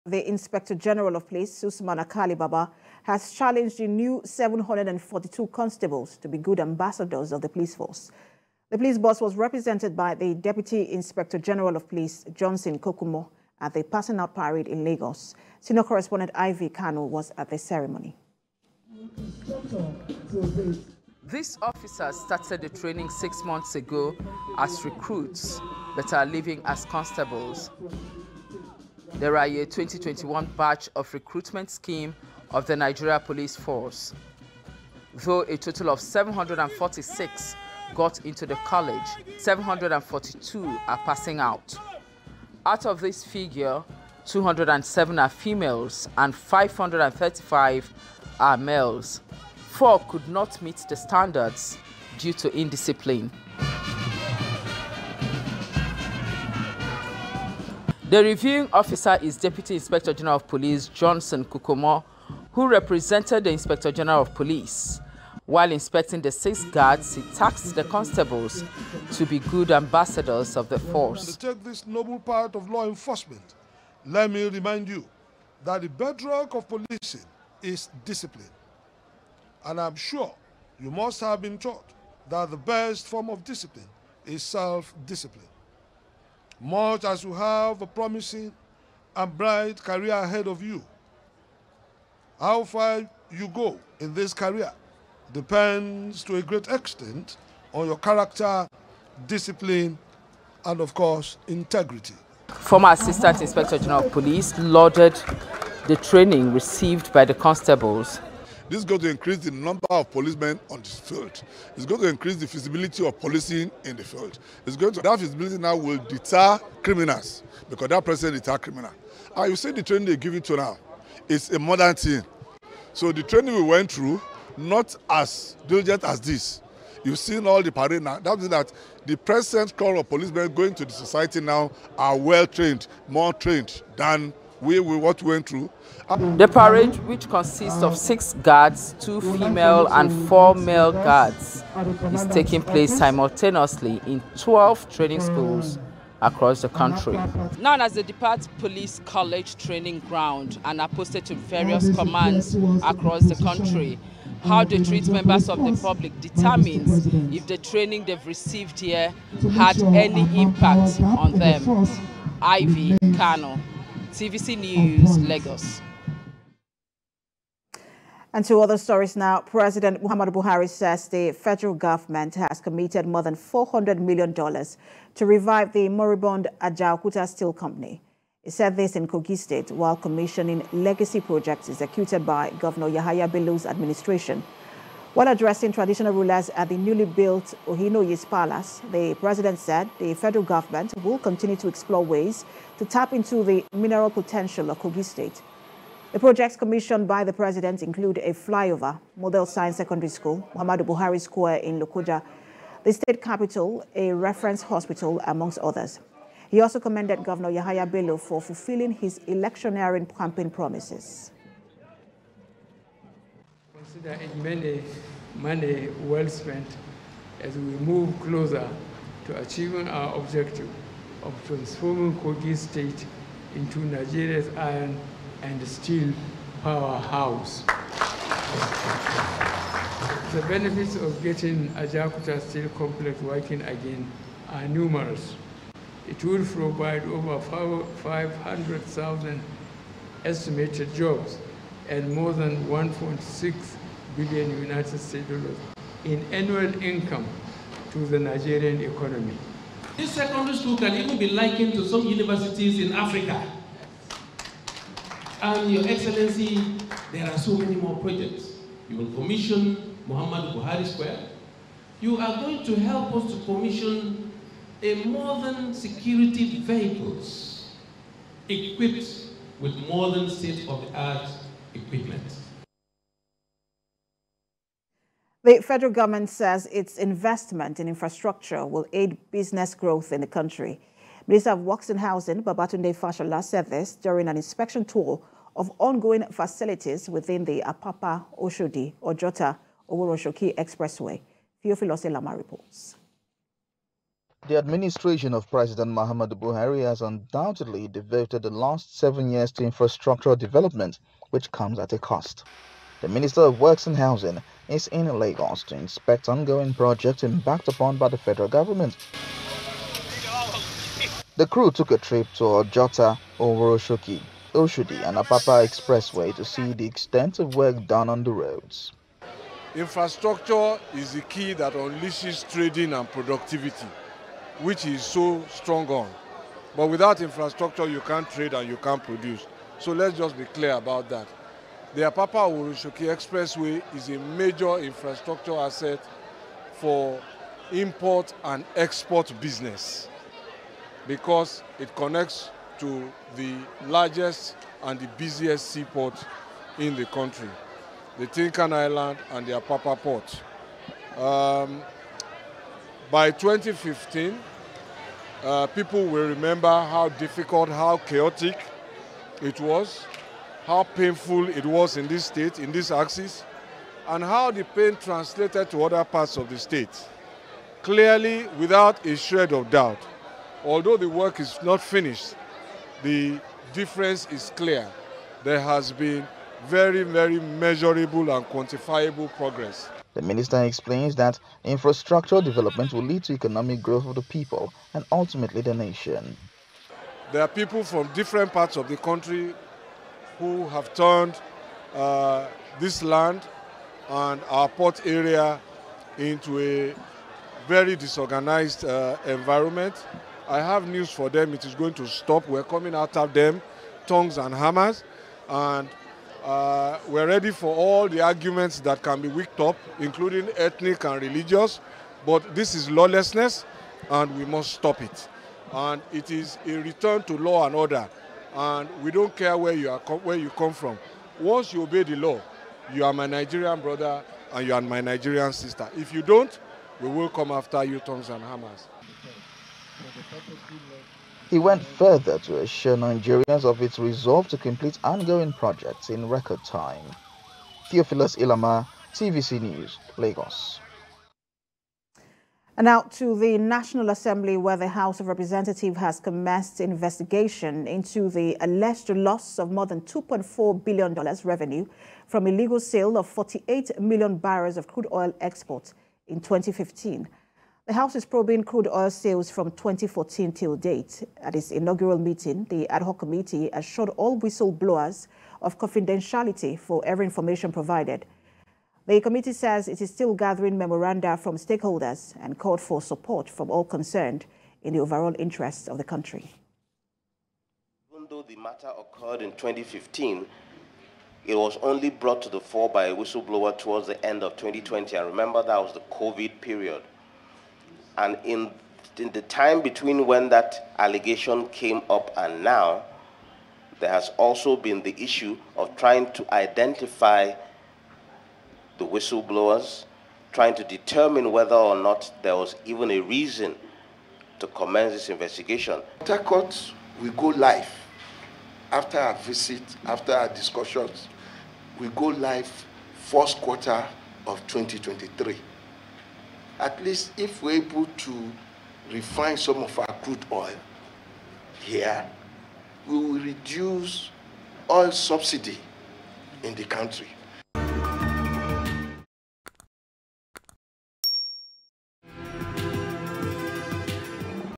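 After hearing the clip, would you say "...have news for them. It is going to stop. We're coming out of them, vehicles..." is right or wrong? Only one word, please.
wrong.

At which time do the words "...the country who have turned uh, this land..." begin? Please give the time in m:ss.
6:28.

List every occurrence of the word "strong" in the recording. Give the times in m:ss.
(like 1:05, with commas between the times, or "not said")
5:25.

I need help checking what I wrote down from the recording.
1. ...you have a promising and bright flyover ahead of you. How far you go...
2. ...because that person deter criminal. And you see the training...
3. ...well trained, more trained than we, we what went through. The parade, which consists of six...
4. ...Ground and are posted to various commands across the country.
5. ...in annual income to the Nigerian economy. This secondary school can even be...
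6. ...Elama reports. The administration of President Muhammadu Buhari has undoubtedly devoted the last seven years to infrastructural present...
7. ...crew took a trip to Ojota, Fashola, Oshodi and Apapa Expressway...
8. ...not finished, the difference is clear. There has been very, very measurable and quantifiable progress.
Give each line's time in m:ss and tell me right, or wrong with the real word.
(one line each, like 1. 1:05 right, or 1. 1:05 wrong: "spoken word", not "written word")
1. 1:27 wrong: "career", not "flyover"
2. 1:57 right
3. 2:12 right
4. 2:30 right
5. 4:06 right
6. 4:52 wrong: "development", not "present"
7. 5:11 wrong: "Oworonshoki", not "Fashola"
8. 6:11 right.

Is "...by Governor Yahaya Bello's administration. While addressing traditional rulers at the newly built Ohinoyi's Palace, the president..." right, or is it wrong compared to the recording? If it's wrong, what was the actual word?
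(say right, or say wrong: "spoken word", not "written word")
right.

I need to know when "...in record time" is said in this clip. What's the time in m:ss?
7:16.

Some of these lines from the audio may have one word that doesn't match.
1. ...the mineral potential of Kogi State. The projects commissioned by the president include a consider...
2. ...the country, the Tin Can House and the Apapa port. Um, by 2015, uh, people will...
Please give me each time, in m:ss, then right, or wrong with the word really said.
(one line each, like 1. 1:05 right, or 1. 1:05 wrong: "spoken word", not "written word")
1. 3:13 wrong: "flyover", not "consider"
2. 5:46 wrong: "Island", not "House".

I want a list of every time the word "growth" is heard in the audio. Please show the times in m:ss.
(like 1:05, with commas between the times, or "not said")
4:39, 6:23.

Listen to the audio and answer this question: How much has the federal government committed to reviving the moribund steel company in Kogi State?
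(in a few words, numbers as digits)
more than $400 million.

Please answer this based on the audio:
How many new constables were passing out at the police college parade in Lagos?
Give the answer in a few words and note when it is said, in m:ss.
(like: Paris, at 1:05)
742, at 0:04.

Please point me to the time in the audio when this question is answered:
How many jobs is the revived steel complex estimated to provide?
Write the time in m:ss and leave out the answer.
3:57.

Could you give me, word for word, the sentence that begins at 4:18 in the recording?
You will commission Muhammadu Buhari Square.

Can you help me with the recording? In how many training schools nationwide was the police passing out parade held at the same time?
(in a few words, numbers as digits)
12.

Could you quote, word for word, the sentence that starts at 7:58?
Even though the matter occurred in 2015, it was only brought to the fore by a whistleblower towards the end of 2020.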